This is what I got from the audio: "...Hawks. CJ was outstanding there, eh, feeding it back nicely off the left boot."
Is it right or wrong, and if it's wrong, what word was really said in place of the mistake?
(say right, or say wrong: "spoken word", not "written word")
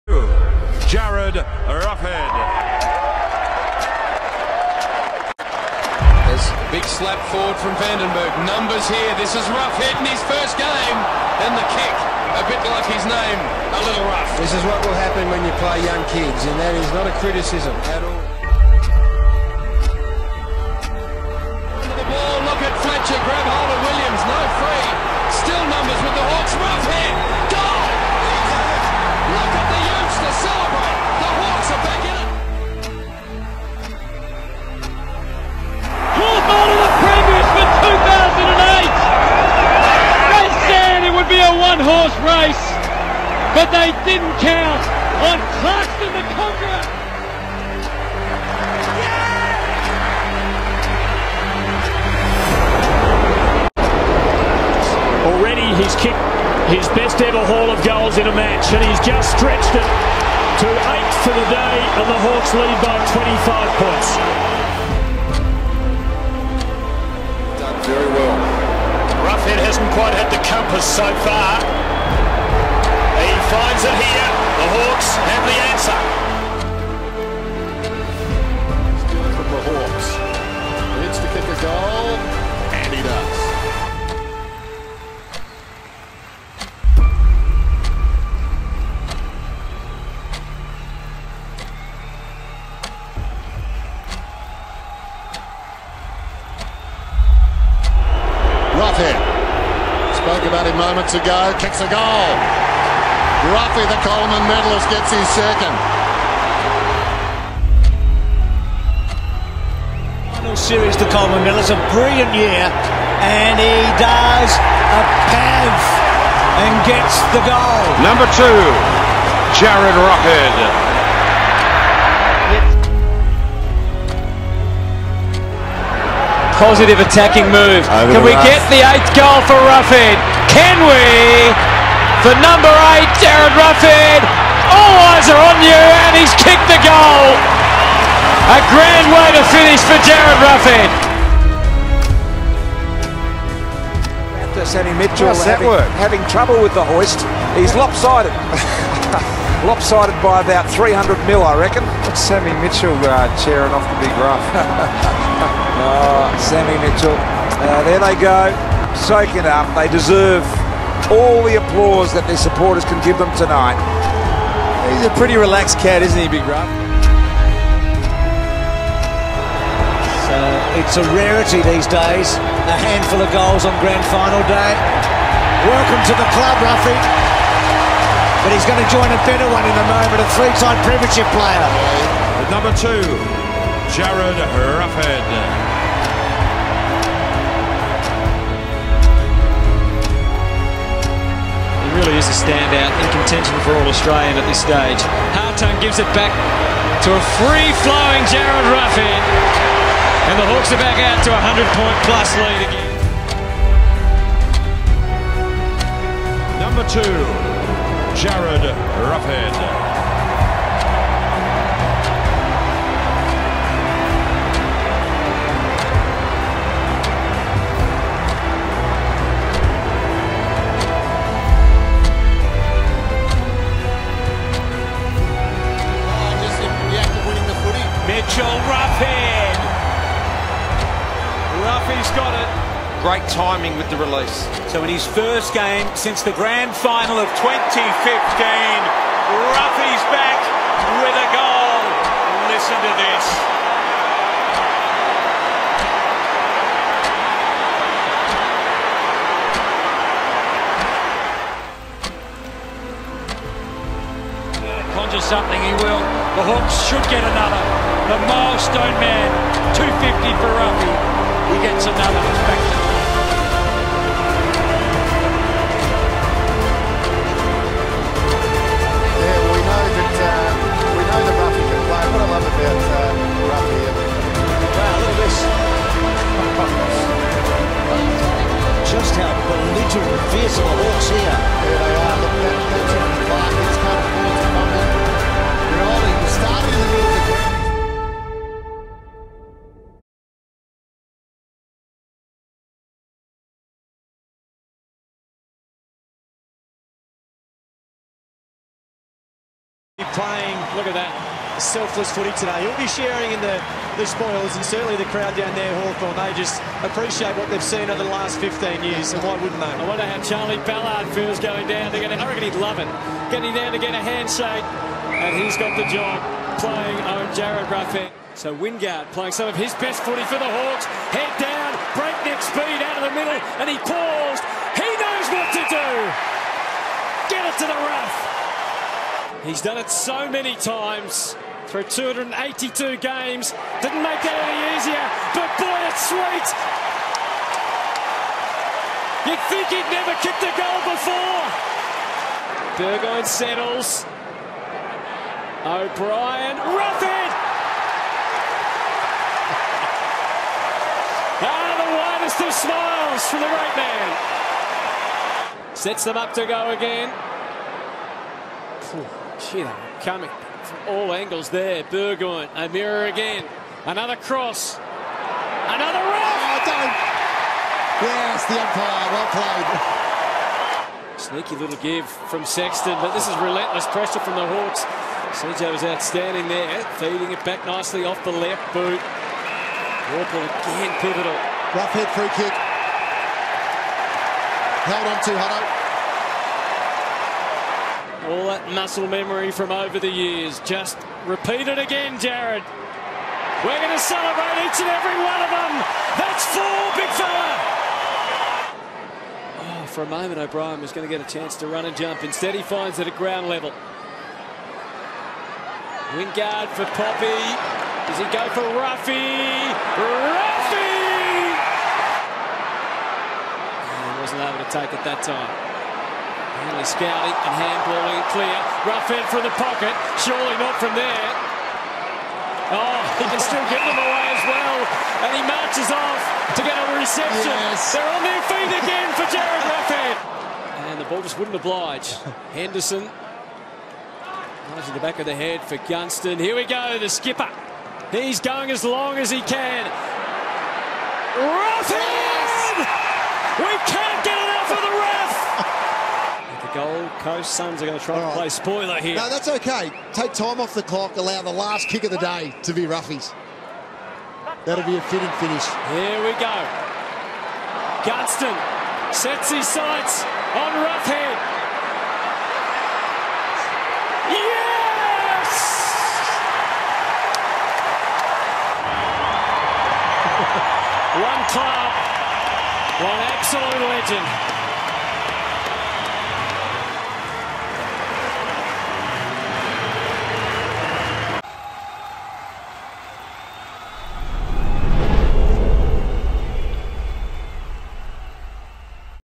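right.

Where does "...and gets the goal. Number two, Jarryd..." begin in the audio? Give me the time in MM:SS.
01:56.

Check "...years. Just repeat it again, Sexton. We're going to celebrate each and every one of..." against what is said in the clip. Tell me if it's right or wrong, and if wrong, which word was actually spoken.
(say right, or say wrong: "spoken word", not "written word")
wrong: "Jarryd", not "Sexton".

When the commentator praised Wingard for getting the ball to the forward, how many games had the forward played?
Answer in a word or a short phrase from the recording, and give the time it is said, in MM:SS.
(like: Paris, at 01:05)
282, at 05:31.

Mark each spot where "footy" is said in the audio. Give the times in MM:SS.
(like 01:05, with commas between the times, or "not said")
05:02, 05:20.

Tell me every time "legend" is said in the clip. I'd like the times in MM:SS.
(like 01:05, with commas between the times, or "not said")
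07:54.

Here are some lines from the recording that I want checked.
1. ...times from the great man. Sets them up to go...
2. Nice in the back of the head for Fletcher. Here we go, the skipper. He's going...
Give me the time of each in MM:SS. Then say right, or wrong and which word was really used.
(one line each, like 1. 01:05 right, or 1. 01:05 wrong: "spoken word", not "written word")
1. 05:52 wrong: "smiles", not "times"
2. 07:14 wrong: "Gunston", not "Fletcher".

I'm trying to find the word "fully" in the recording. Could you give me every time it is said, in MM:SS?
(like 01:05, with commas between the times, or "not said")
not said.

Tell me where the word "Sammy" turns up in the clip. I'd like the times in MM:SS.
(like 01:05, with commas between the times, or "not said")
02:24, 02:32, 02:36.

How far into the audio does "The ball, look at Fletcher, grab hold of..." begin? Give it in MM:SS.
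00:21.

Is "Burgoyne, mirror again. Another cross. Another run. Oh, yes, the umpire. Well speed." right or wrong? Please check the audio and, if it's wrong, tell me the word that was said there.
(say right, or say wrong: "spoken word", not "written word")
wrong: "played", not "speed".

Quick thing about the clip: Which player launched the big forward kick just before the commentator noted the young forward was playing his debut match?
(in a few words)
Vandenberg.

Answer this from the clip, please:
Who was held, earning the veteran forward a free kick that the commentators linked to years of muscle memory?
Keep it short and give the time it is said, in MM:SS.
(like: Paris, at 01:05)
Hutto, at 06:25.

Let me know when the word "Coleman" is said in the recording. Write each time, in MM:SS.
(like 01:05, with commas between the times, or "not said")
01:44, 01:51.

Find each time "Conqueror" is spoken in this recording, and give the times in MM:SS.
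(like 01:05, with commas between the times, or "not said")
00:46.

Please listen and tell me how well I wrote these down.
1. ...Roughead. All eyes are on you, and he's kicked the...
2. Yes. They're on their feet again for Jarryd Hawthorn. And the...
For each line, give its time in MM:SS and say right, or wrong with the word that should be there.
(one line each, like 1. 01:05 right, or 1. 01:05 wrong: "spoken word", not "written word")
1. 02:13 right
2. 07:07 wrong: "Roughead", not "Hawthorn".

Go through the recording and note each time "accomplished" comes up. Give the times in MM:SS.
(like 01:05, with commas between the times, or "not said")
not said.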